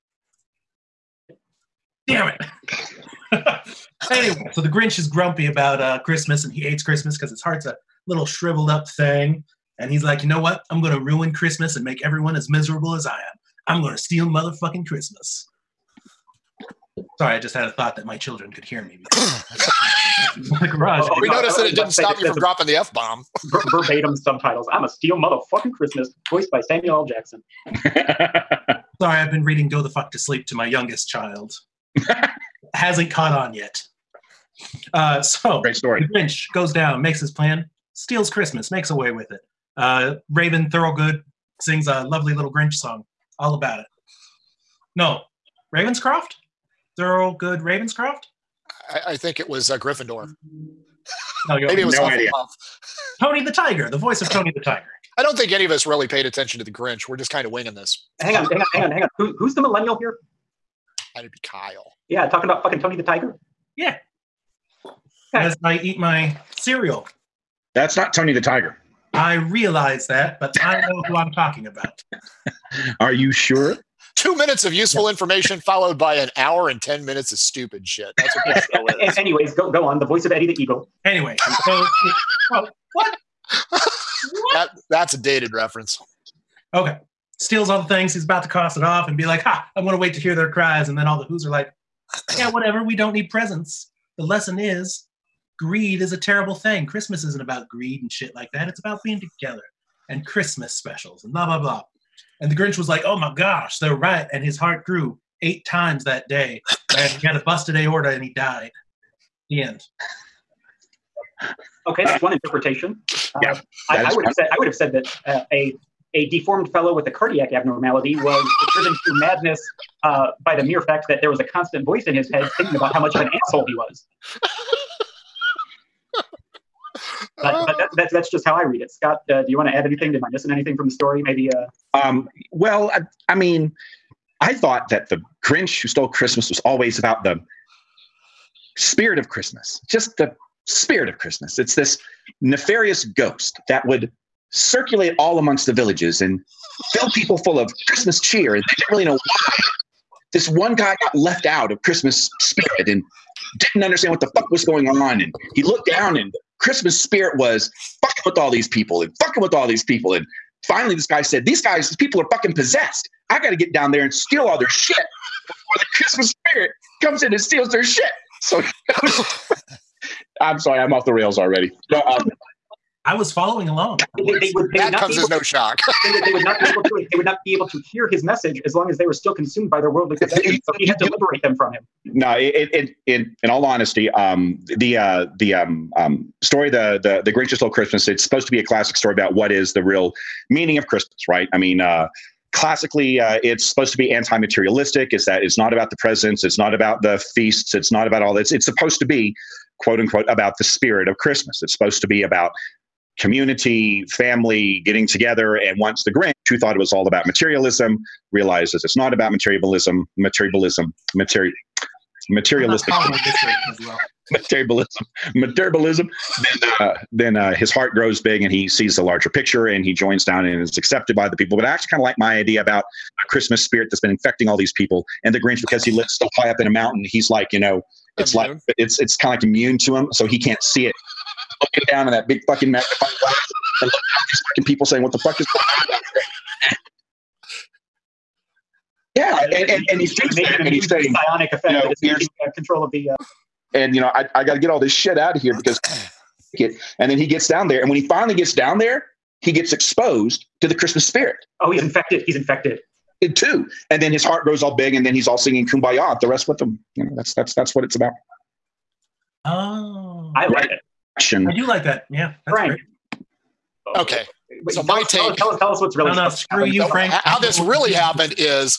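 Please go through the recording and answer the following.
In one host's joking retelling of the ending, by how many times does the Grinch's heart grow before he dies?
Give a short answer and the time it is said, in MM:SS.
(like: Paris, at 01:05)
8, at 01:45.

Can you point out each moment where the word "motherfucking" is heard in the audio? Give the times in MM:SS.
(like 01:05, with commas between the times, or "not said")
00:14, 00:25.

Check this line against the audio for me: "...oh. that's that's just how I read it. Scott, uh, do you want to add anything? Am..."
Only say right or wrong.
right.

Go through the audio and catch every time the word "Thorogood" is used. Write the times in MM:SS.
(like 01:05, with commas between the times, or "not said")
00:40, 00:46.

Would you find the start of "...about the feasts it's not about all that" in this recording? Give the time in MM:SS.
03:16.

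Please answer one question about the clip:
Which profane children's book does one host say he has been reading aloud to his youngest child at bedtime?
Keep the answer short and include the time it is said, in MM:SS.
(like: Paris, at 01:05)
Go the Fuck to Sleep, at 00:29.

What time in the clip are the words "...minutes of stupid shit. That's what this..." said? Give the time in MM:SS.
01:17.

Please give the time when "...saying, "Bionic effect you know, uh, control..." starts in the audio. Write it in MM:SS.
04:00.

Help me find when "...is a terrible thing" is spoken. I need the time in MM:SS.
01:36.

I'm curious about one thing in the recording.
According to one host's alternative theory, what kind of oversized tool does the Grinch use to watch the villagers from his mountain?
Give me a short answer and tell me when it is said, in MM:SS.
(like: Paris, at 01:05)
magnifying glass, at 03:52.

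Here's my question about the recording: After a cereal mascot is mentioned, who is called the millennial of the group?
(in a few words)
Kyle.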